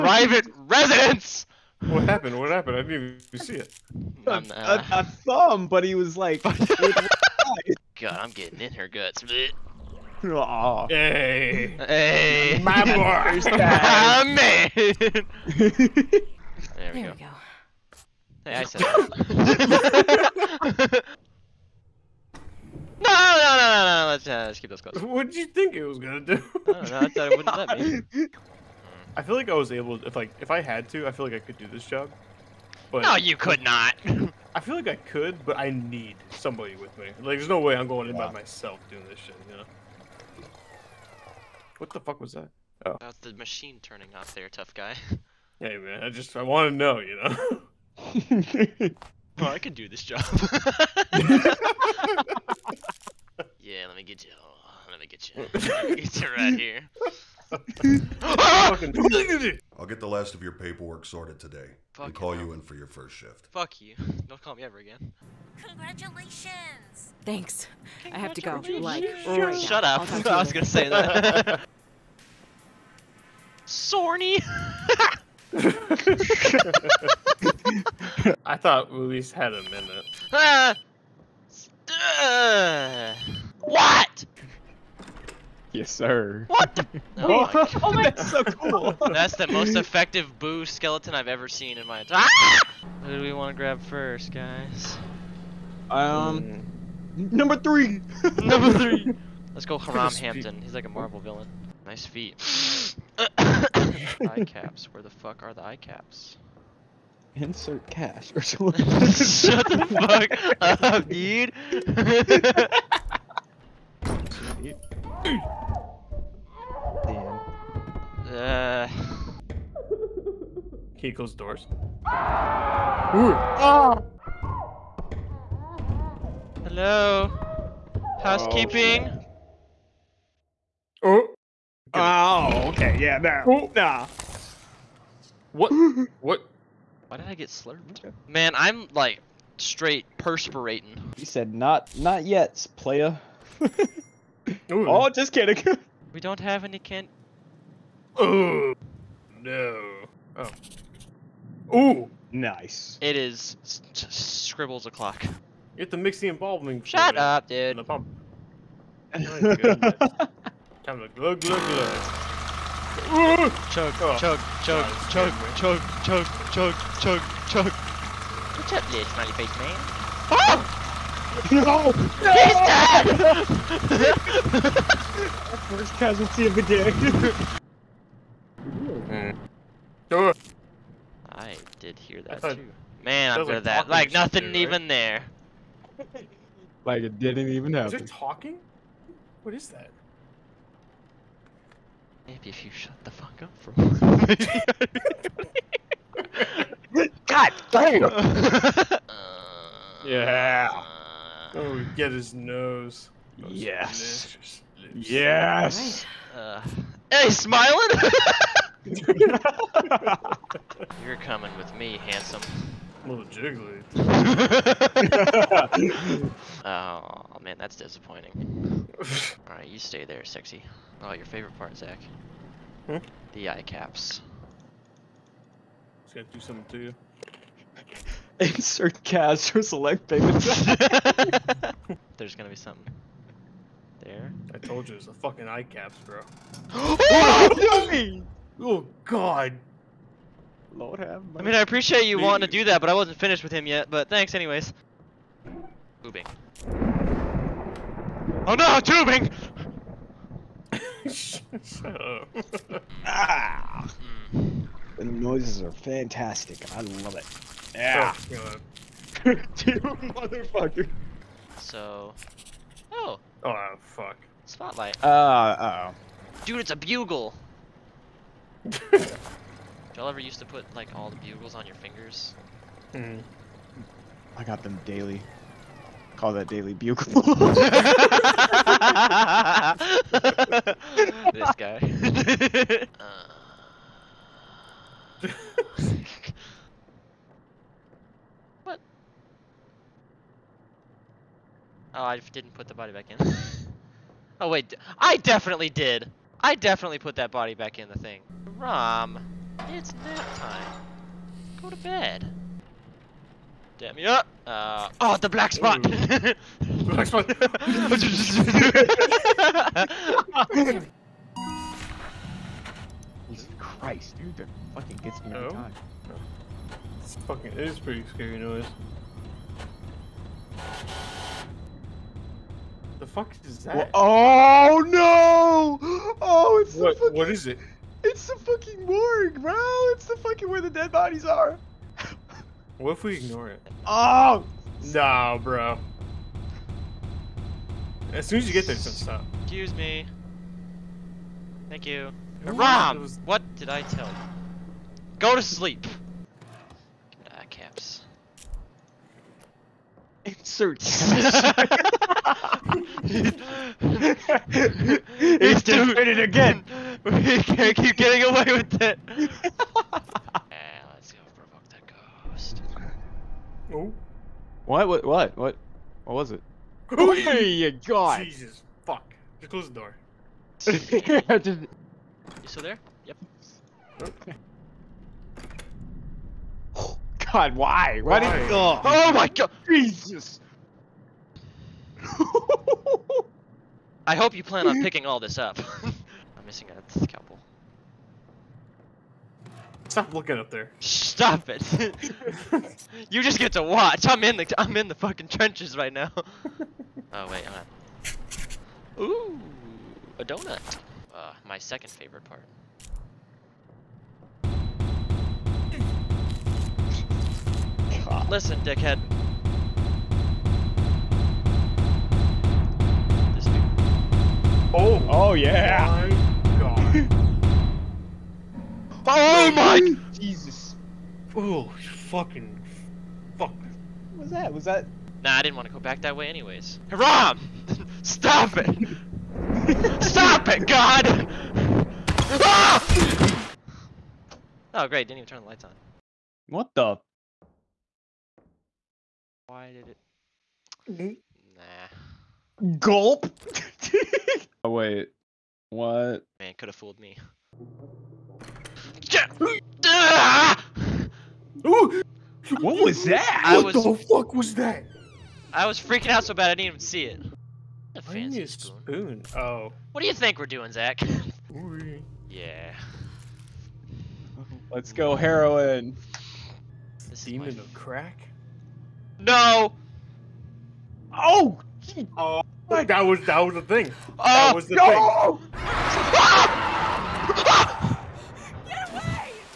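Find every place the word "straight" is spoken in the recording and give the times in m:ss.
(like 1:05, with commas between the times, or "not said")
2:19.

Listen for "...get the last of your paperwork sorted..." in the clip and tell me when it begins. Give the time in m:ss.
0:59.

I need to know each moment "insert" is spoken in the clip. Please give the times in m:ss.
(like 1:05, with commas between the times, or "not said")
1:47, 3:48, 5:50.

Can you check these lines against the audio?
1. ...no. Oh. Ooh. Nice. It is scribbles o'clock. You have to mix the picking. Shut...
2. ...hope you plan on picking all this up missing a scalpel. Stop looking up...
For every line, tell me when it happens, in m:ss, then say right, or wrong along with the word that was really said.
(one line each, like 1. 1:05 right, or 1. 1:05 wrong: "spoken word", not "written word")
1. 2:29 wrong: "embalming", not "picking"
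2. 6:24 right.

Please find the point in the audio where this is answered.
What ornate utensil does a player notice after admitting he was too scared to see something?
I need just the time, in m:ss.
7:37.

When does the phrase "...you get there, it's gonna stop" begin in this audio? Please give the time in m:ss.
5:38.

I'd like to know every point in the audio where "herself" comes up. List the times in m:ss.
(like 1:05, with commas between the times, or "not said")
not said.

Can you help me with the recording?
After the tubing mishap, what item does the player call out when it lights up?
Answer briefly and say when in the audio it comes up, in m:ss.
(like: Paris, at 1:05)
Spotlight, at 4:24.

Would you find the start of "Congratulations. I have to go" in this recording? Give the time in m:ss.
1:08.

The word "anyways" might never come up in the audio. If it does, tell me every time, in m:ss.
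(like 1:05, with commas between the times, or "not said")
4:04, 7:06.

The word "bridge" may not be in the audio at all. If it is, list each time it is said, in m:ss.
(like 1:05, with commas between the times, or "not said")
not said.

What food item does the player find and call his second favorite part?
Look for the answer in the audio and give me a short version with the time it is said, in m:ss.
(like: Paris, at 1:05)
A donut, at 6:40.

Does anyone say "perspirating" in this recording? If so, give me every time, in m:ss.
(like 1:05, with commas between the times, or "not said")
2:20.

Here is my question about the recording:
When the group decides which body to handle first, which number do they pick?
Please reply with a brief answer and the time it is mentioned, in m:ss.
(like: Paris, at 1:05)
3, at 1:37.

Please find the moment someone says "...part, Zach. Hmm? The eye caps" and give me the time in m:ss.
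3:41.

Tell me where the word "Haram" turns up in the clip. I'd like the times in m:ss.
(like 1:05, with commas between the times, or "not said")
1:39, 7:06.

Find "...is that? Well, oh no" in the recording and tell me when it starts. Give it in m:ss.
5:23.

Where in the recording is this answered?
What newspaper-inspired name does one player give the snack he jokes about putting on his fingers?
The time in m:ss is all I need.
4:36.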